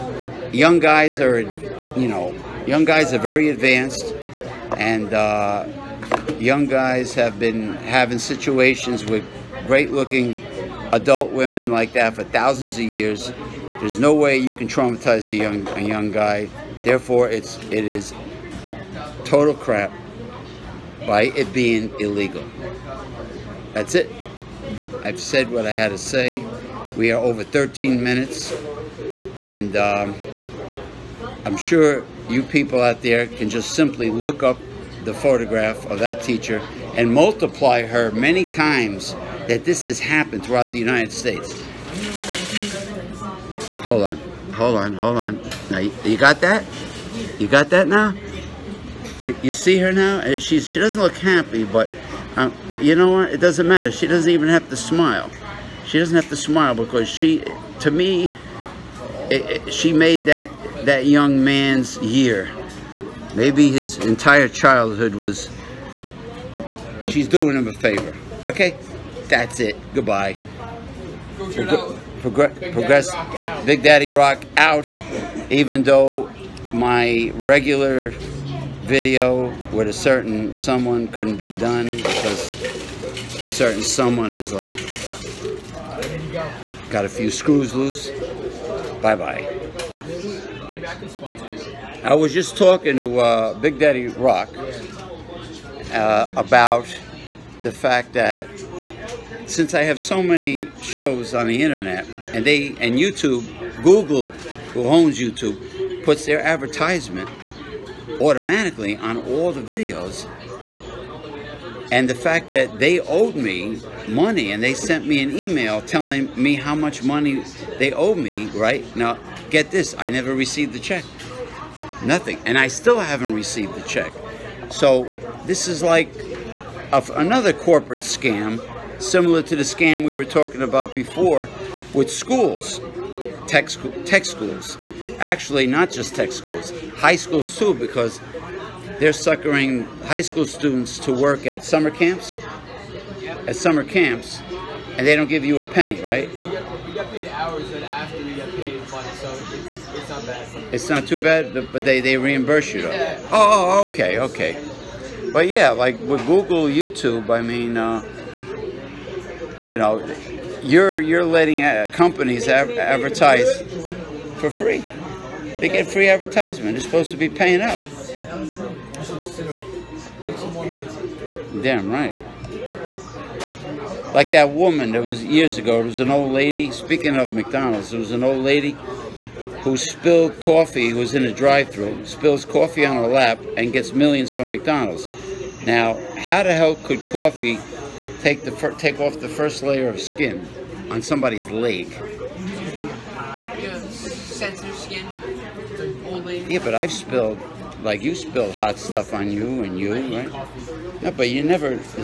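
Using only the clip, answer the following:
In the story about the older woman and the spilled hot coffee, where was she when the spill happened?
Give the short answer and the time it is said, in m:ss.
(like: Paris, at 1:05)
drive-through, at 3:01.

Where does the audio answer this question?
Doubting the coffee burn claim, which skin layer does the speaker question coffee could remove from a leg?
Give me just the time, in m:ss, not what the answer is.
3:09.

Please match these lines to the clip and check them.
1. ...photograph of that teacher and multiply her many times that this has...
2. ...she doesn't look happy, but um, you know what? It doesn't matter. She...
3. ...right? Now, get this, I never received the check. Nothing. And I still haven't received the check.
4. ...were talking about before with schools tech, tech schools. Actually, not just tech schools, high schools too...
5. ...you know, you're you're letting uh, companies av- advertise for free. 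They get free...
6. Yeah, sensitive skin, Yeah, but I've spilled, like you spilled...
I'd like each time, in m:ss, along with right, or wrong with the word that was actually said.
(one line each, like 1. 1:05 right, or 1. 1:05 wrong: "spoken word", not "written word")
1. 0:35 right
2. 0:50 right
3. 1:58 right
4. 2:10 right
5. 2:39 right
6. 3:13 right.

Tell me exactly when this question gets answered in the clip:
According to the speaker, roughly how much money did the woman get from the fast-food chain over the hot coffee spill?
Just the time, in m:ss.
3:03.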